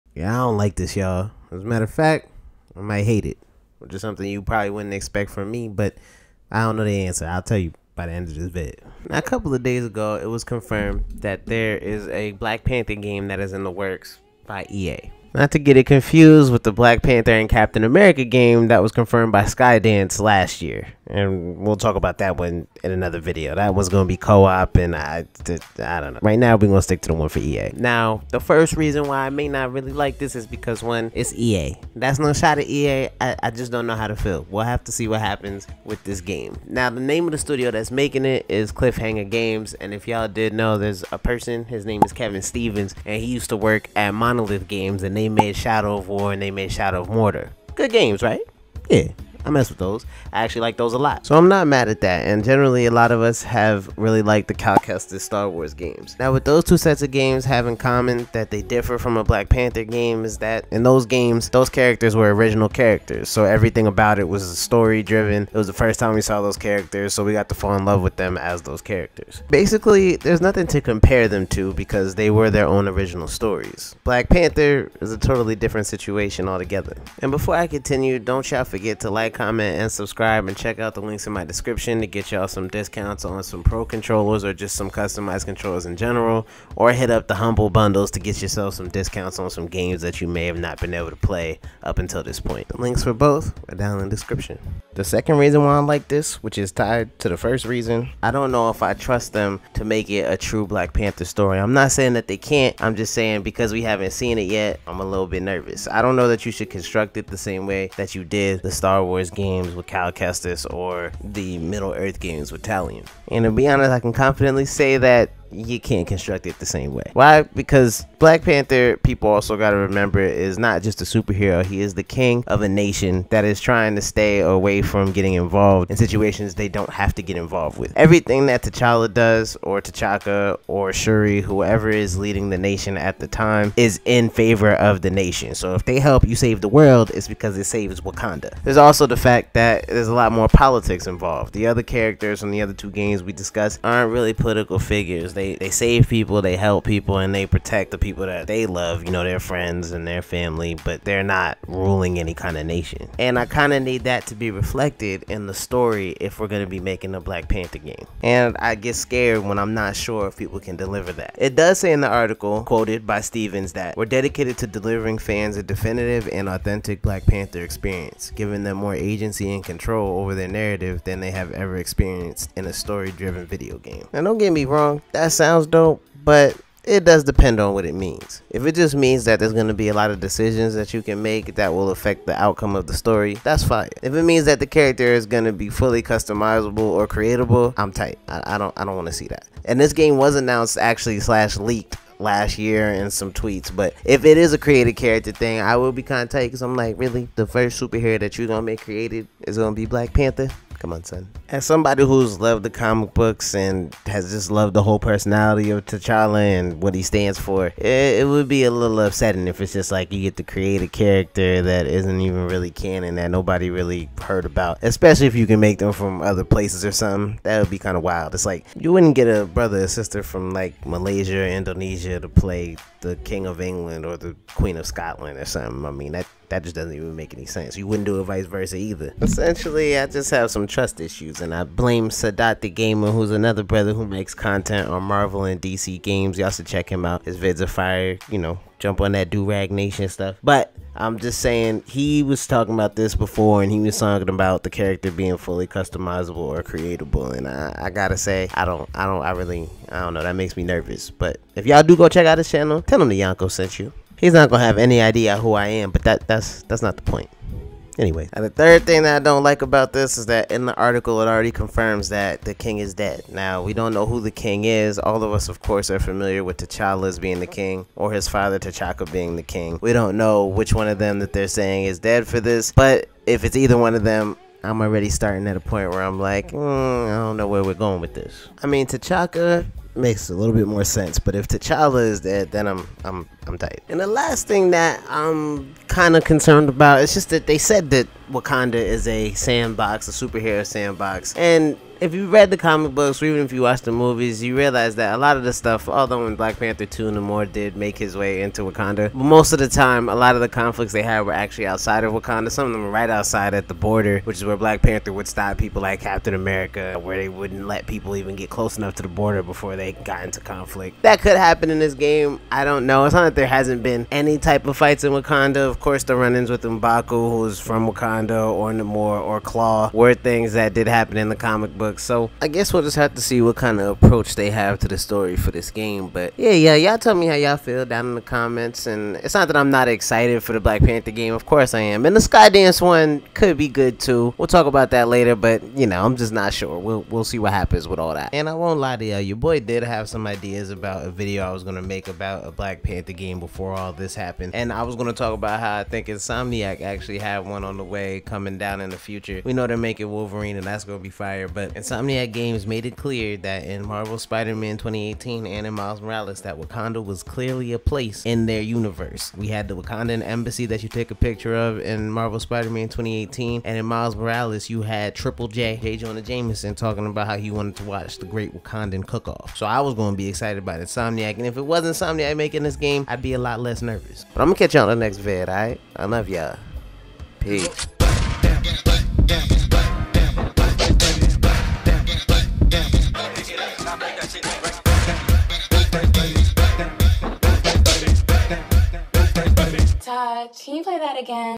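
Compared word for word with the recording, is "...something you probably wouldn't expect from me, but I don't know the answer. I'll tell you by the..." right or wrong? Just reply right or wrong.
right.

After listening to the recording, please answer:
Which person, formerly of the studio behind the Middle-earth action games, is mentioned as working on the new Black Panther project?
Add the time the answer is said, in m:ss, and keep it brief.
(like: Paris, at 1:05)
Kevin Stevens, at 0:42.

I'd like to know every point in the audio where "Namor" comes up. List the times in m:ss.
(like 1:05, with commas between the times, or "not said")
4:57, 5:18.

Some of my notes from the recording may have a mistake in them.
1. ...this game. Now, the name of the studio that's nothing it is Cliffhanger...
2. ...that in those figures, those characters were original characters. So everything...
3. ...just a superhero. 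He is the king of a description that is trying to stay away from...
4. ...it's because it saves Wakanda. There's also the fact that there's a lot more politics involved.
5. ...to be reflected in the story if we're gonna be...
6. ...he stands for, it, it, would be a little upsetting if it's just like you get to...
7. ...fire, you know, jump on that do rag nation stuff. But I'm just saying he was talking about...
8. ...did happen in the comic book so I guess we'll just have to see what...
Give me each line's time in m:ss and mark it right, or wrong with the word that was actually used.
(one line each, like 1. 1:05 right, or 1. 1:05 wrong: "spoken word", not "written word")
1. 0:36 wrong: "making", not "nothing"
2. 1:00 wrong: "games", not "figures"
3. 2:00 wrong: "nation", not "description"
4. 2:17 right
5. 2:34 right
6. 3:26 right
7. 3:57 right
8. 5:20 right.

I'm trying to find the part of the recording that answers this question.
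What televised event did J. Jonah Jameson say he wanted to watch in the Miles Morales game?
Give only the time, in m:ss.
6:08.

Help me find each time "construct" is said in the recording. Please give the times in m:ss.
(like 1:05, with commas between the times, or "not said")
1:46, 1:56.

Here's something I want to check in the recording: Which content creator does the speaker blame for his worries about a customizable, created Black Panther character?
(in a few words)
Sadat the Gamer.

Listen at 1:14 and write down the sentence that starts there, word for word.
Black Panther is a totally different situation altogether.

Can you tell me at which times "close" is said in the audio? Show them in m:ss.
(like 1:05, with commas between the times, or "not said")
5:08.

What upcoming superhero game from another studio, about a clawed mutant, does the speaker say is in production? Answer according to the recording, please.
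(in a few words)
Wolverine.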